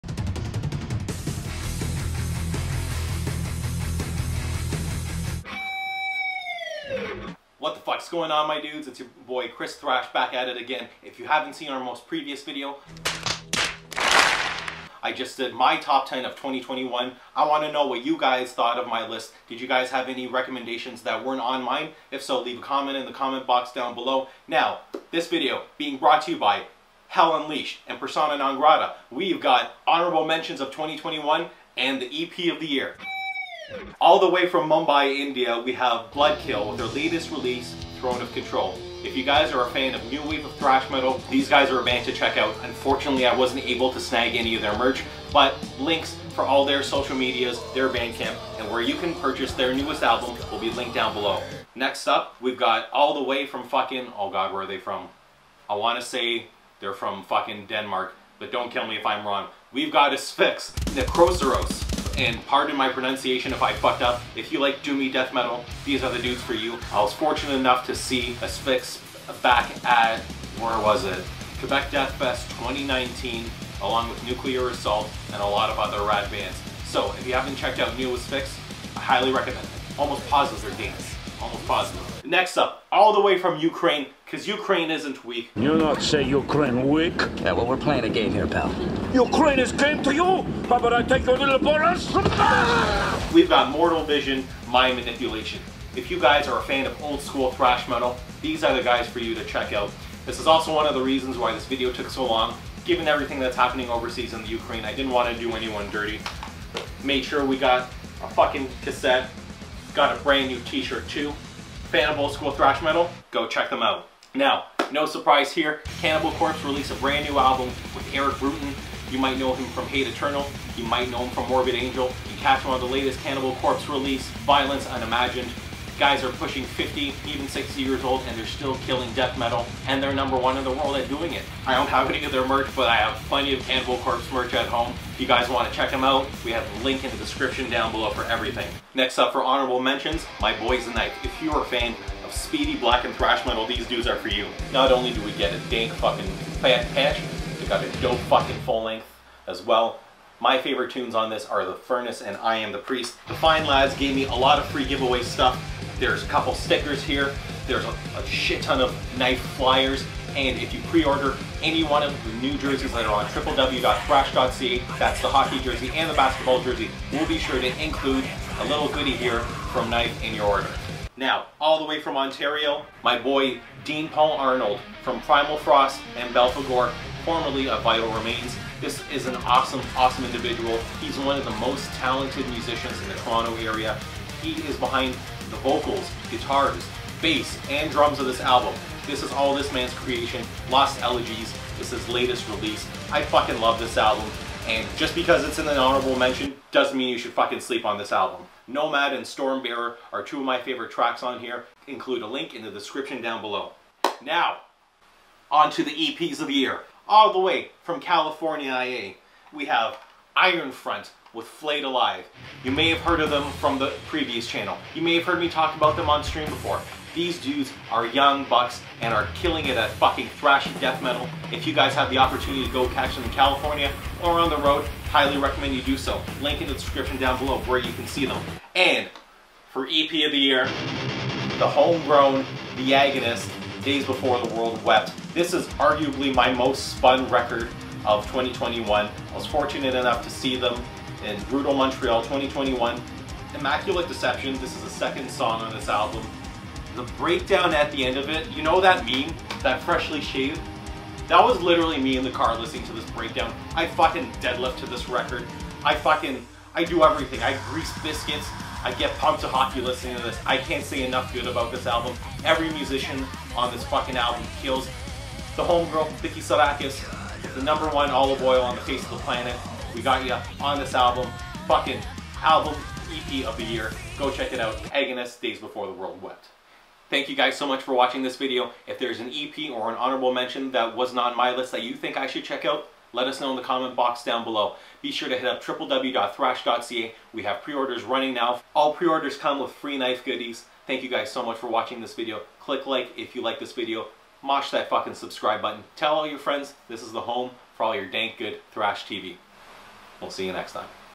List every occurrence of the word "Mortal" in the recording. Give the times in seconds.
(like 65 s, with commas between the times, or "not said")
93 s.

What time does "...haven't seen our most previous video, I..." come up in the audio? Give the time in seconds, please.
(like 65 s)
11 s.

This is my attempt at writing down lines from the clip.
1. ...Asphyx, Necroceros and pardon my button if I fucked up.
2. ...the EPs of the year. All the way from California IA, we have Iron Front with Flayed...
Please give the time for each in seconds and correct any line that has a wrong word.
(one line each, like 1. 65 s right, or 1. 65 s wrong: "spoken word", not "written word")
1. 60 s wrong: "pronunciation", not "button"
2. 205 s right.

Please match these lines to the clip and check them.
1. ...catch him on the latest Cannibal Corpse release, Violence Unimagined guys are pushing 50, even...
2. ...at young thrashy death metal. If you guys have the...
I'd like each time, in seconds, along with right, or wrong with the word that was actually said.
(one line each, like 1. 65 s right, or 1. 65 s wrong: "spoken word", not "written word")
1. 122 s right
2. 219 s wrong: "fucking", not "young".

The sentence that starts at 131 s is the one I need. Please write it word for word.
I don't have any of their merch, but I have plenty of Cannibal Corpse merch at home.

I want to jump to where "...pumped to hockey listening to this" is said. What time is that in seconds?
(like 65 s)
259 s.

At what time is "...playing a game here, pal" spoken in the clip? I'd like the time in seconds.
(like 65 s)
87 s.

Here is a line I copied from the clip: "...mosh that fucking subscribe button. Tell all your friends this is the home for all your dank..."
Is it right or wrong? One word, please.
right.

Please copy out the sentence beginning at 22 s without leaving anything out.
If so, leave a comment in the comment box down below.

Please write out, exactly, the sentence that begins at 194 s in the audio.
And just because it's in an honorable mention doesn't mean you should fucking sleep on this album.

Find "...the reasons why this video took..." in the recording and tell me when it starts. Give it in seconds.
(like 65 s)
100 s.